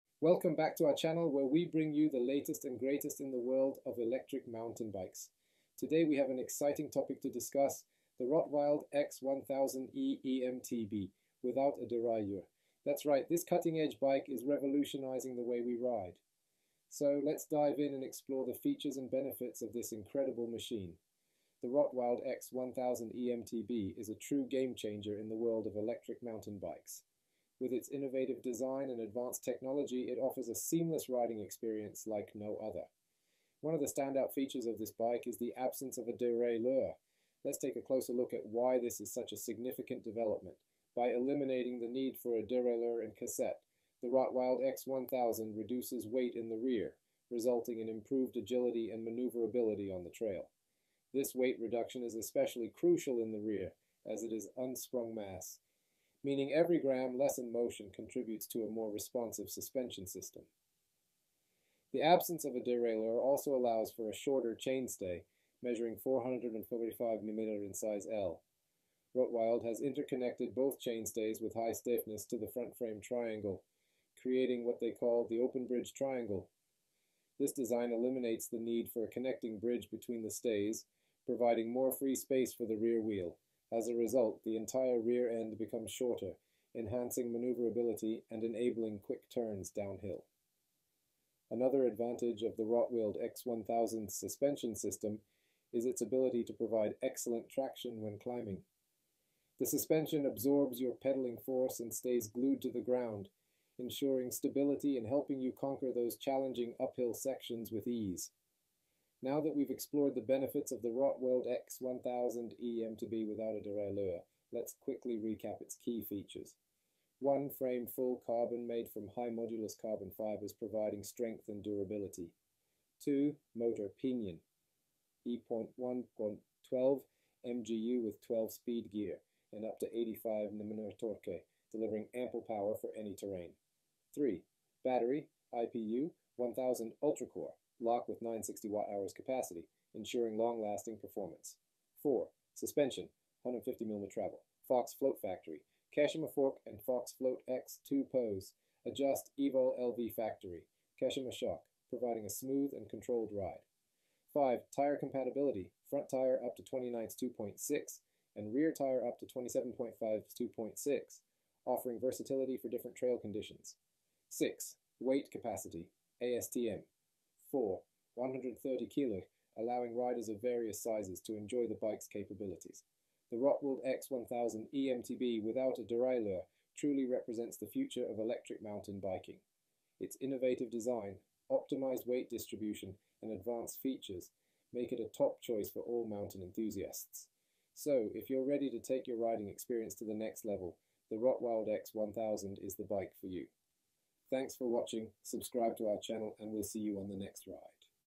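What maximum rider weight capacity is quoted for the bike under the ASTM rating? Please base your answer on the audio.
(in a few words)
130 kg.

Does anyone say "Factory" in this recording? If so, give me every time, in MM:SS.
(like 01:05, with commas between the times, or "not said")
02:25, 02:30.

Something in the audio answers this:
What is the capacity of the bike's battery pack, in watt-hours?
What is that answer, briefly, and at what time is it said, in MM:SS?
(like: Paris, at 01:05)
960 watt-hours, at 02:18.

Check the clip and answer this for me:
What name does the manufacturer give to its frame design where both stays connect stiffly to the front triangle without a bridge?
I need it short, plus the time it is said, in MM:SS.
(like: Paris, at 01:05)
open bridge triangle, at 01:15.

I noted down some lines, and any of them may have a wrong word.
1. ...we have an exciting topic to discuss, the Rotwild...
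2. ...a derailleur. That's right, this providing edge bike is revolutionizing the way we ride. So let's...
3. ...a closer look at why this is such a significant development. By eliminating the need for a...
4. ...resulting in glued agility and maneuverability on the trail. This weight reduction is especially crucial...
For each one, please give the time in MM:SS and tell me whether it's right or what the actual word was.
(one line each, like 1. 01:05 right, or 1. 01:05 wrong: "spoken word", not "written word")
1. 00:06 right
2. 00:11 wrong: "cutting", not "providing"
3. 00:37 right
4. 00:47 wrong: "improved", not "glued".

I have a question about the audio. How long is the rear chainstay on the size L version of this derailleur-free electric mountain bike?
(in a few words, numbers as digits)
445 mm.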